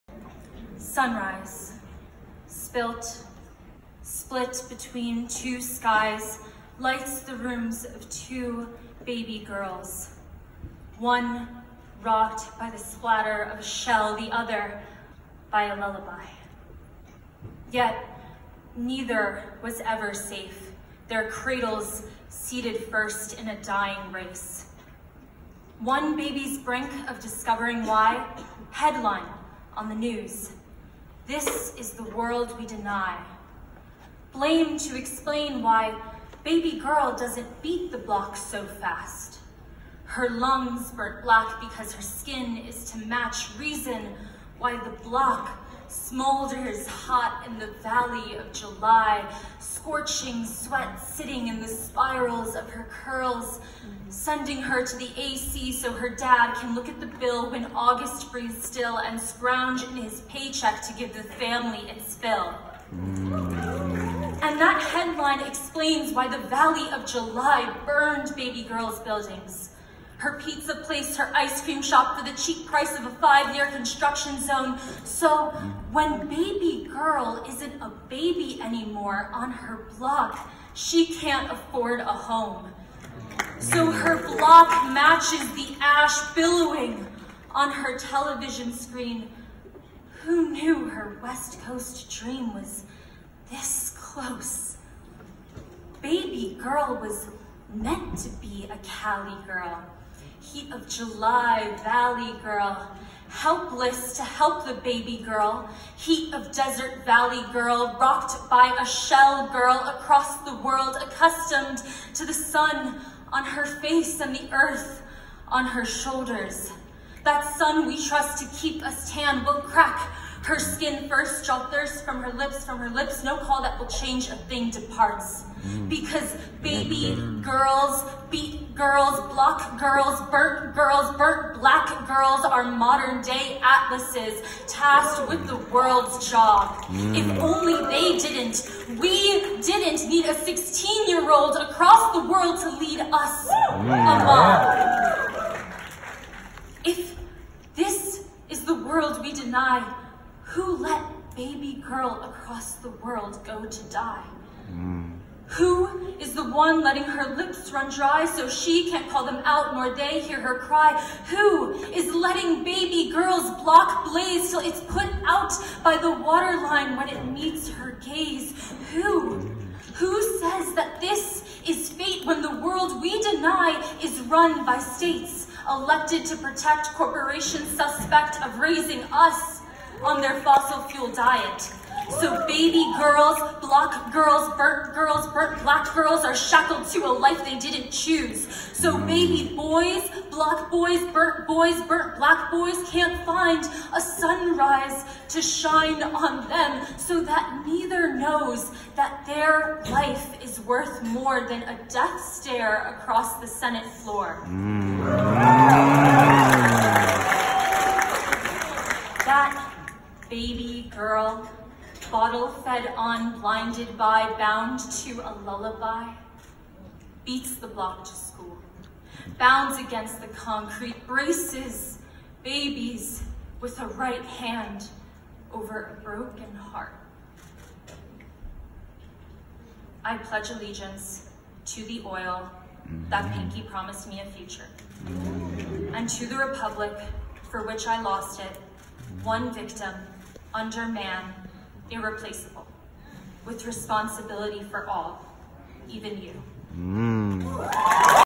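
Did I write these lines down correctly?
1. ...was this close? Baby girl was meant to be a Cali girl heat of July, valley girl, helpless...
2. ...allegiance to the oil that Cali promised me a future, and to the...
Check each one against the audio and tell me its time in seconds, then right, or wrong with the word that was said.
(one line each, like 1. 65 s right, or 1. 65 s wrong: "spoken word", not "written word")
1. 92 s right
2. 230 s wrong: "Pinky", not "Cali".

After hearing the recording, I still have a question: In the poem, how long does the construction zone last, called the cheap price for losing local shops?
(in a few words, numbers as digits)
5 years.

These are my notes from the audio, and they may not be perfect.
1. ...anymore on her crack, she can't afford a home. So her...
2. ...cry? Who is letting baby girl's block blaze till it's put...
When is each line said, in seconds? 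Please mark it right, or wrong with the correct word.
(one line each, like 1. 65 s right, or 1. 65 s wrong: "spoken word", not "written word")
1. 78 s wrong: "block", not "crack"
2. 160 s right.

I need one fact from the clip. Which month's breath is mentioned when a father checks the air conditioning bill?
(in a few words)
August.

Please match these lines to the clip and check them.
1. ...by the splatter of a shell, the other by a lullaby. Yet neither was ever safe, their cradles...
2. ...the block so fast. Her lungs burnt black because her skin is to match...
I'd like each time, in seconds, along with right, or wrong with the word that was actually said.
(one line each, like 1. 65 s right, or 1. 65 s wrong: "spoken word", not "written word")
1. 12 s right
2. 37 s right.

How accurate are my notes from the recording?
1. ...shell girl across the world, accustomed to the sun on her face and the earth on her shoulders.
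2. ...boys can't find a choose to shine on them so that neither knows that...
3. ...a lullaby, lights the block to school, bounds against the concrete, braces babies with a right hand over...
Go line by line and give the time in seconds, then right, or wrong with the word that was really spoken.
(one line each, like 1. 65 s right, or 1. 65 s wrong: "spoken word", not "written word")
1. 108 s right
2. 192 s wrong: "sunrise", not "choose"
3. 215 s wrong: "beats", not "lights".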